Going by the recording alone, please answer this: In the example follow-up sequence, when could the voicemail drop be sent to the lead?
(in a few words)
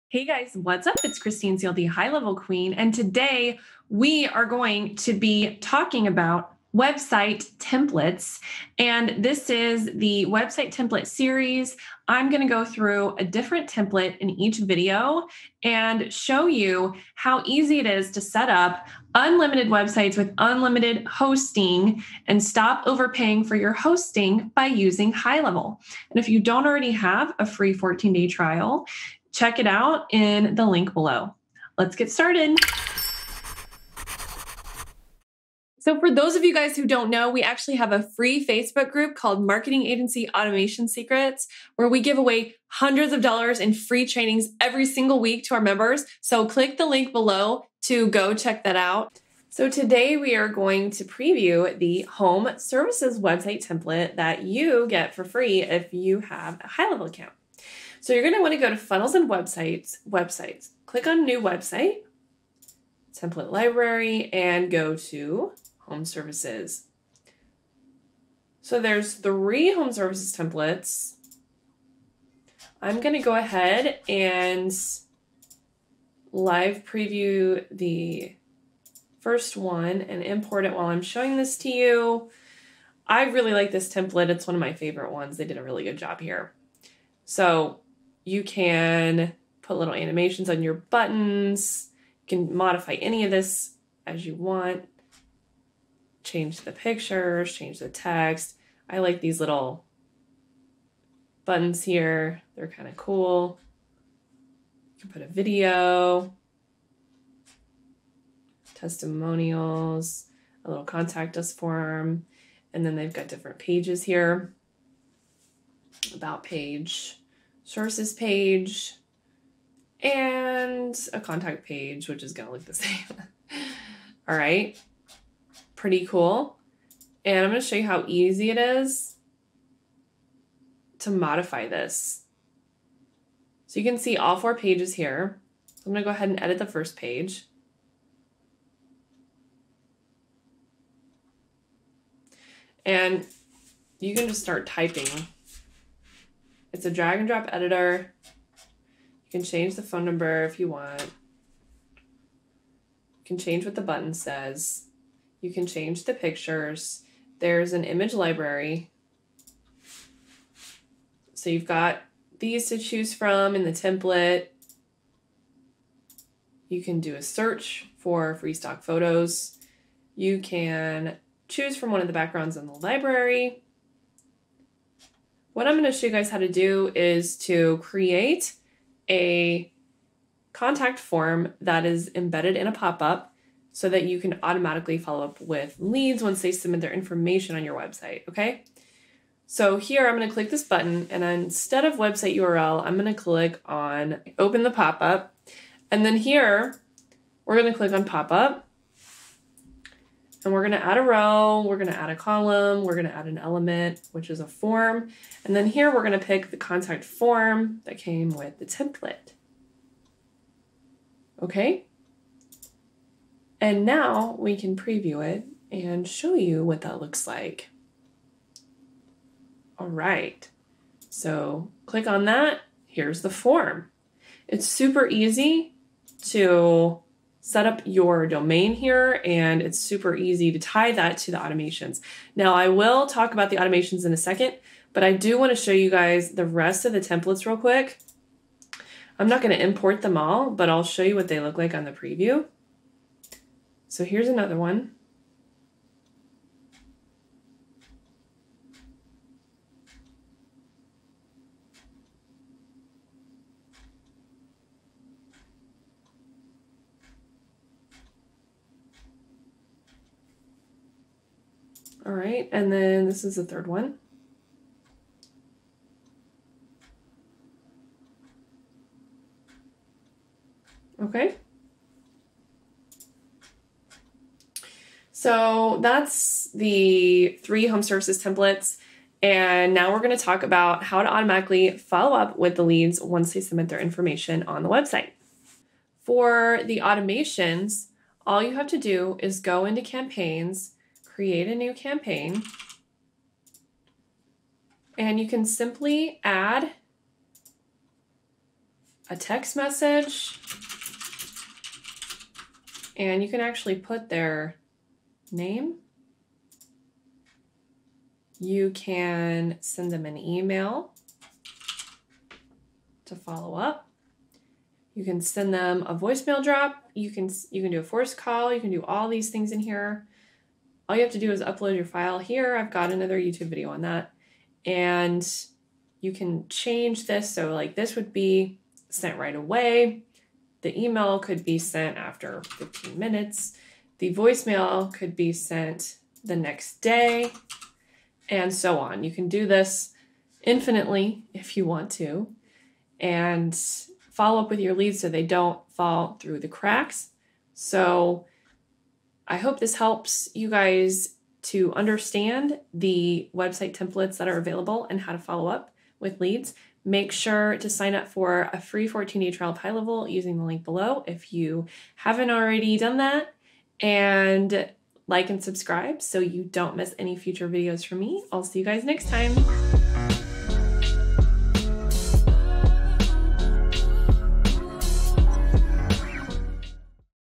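the next day.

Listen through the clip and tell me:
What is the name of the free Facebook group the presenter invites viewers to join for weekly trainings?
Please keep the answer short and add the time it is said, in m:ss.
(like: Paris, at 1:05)
Marketing Agency Automation Secrets, at 0:39.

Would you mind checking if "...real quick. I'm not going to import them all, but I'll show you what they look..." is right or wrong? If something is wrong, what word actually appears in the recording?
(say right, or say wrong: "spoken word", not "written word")
right.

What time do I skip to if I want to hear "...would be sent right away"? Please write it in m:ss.
5:27.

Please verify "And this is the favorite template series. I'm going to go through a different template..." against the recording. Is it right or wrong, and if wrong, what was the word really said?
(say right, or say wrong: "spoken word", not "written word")
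wrong: "website", not "favorite".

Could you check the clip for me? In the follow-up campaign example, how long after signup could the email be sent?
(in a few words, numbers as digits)
15 minutes.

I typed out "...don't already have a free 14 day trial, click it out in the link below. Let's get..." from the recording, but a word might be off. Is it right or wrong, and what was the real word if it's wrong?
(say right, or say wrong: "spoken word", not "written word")
wrong: "check", not "click".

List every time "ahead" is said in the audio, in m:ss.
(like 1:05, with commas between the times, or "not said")
1:13, 2:16.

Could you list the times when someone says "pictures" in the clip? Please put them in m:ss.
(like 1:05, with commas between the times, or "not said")
1:36, 2:36.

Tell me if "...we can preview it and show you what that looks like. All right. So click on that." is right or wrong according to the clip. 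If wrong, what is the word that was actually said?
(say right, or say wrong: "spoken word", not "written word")
right.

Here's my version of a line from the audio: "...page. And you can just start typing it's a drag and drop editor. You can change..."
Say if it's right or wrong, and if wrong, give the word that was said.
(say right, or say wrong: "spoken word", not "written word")
right.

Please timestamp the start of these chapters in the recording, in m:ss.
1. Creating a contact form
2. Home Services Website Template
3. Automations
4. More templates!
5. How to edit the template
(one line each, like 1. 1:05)
1. 2:55
2. 0:48
3. 4:34
4. 3:54
5. 2:06.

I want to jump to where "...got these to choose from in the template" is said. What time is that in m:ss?
2:41.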